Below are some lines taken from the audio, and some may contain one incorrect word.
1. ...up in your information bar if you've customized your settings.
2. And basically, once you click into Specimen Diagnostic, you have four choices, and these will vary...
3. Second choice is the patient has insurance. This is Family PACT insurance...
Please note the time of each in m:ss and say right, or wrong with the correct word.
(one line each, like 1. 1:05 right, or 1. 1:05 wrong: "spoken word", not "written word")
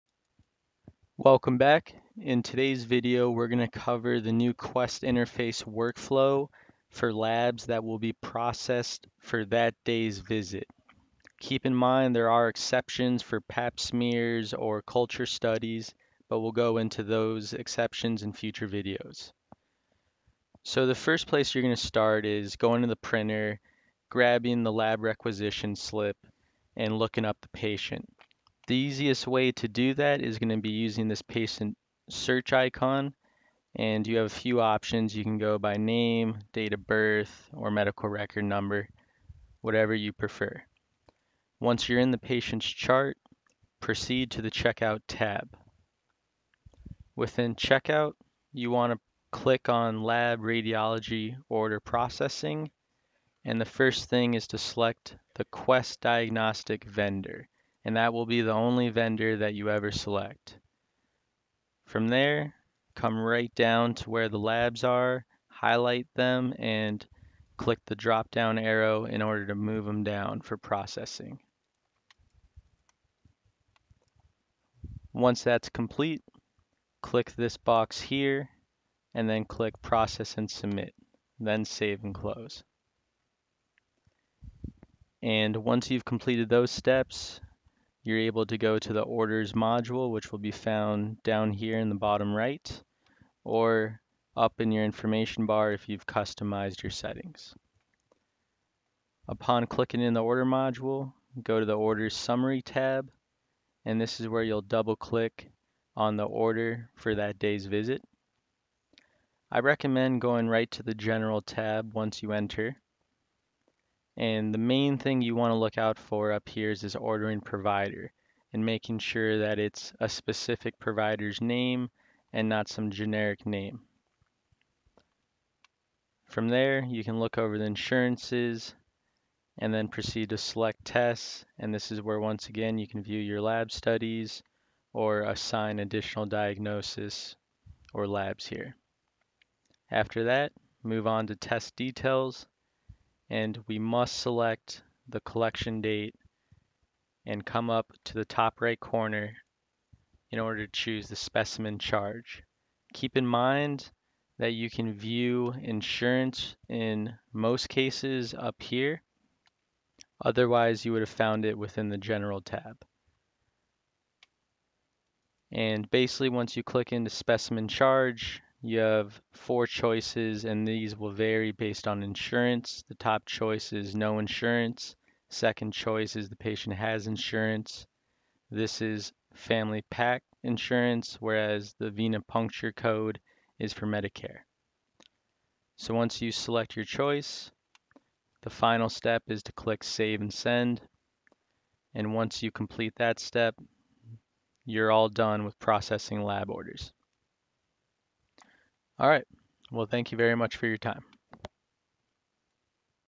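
1. 1:34 right
2. 2:45 wrong: "Charge", not "Diagnostic"
3. 2:55 right.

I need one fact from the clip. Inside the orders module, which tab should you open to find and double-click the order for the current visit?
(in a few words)
orders summary.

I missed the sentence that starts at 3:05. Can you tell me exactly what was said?
So once you select your choice, the final step is to click Save and Send.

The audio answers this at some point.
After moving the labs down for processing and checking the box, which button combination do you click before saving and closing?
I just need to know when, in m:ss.
1:19.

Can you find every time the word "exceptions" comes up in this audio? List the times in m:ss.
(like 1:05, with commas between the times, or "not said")
0:12, 0:17.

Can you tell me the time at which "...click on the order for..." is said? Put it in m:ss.
1:44.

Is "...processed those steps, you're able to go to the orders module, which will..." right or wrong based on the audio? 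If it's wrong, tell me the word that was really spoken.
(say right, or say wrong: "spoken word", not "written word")
wrong: "completed", not "processed".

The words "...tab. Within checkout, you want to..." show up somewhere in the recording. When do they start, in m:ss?
0:45.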